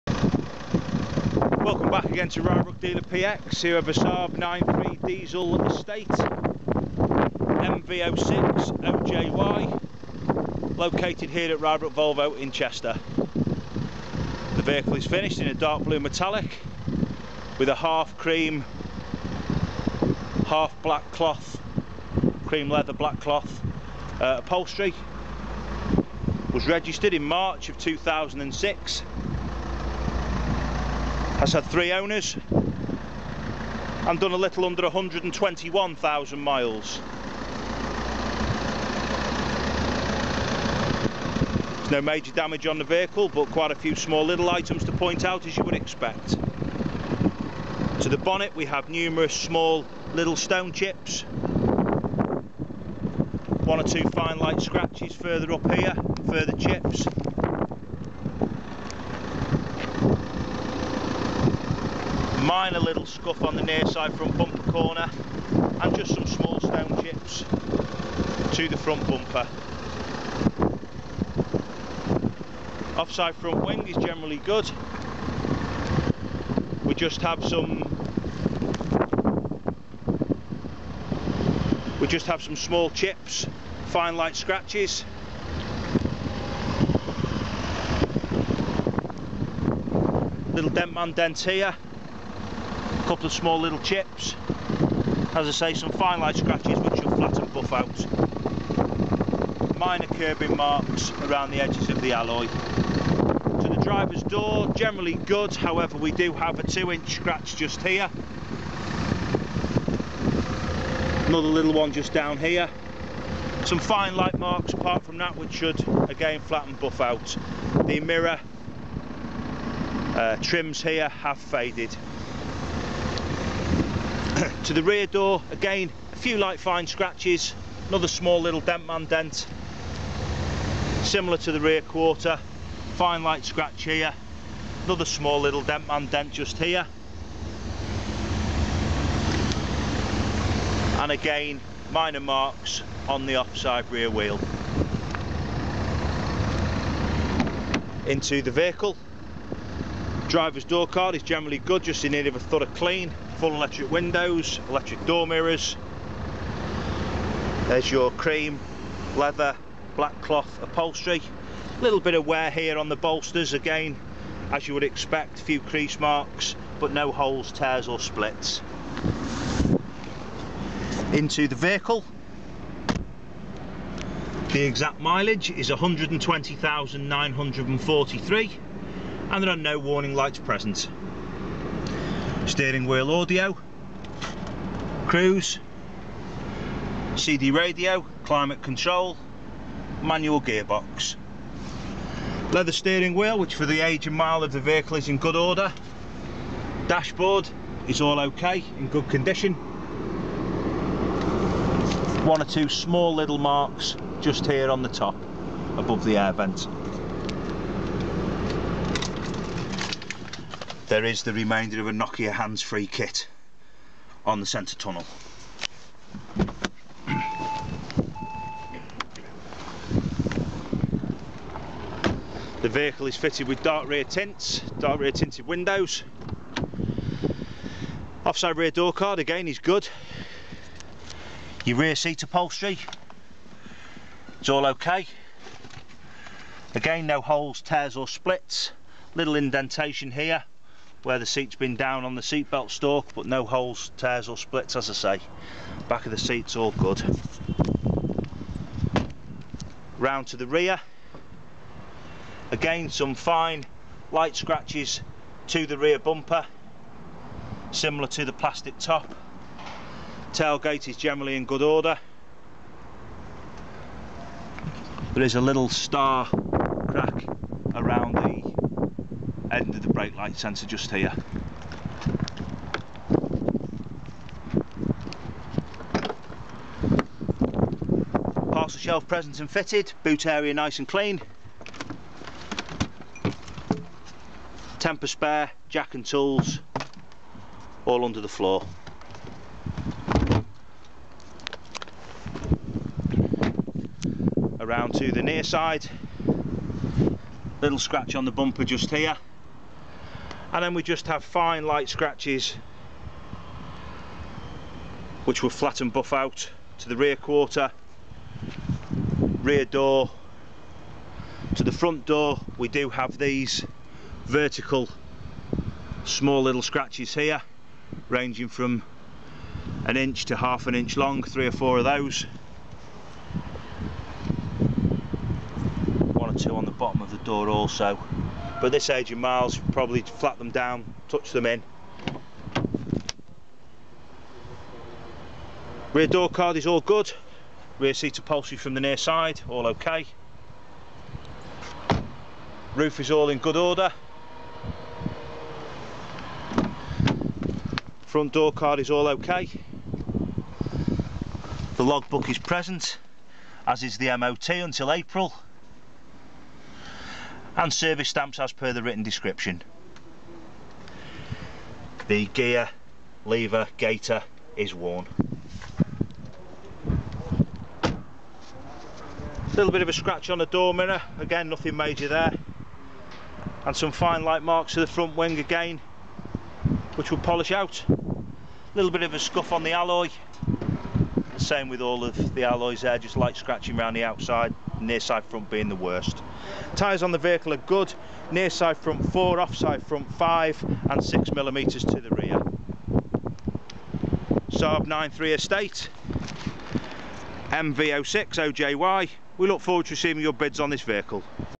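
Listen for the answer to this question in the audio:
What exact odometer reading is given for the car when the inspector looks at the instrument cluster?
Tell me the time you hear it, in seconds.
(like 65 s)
175 s.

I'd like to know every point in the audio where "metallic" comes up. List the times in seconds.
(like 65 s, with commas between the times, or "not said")
15 s.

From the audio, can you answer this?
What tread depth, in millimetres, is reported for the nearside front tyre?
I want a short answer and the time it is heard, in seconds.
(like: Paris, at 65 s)
4, at 389 s.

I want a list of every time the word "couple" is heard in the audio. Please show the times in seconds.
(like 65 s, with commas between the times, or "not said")
93 s.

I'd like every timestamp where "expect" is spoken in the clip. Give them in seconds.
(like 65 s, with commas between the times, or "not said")
45 s, 164 s.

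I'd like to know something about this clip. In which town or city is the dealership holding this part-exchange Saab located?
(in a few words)
Chester.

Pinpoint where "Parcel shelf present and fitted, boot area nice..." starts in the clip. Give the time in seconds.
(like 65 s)
278 s.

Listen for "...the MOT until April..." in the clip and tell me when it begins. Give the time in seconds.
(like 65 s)
353 s.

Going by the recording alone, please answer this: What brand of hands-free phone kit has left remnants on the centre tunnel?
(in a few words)
Nokia.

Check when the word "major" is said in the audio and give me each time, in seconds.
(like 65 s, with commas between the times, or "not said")
41 s, 371 s.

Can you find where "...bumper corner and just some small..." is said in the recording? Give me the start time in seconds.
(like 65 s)
64 s.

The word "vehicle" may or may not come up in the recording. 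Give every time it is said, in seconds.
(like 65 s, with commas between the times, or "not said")
14 s, 42 s, 148 s, 171 s, 194 s, 222 s, 387 s, 400 s.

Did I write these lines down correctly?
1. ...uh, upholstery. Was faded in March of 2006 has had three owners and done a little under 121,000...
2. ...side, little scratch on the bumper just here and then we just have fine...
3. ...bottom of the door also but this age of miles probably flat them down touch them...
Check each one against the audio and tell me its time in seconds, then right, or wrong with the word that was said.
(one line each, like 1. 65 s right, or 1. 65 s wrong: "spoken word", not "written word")
1. 24 s wrong: "registered", not "faded"
2. 295 s right
3. 326 s right.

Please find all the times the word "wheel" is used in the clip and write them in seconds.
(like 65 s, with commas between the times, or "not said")
144 s, 182 s, 193 s.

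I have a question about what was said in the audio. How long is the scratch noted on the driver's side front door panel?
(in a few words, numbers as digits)
2 inches.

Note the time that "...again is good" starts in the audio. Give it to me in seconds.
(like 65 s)
229 s.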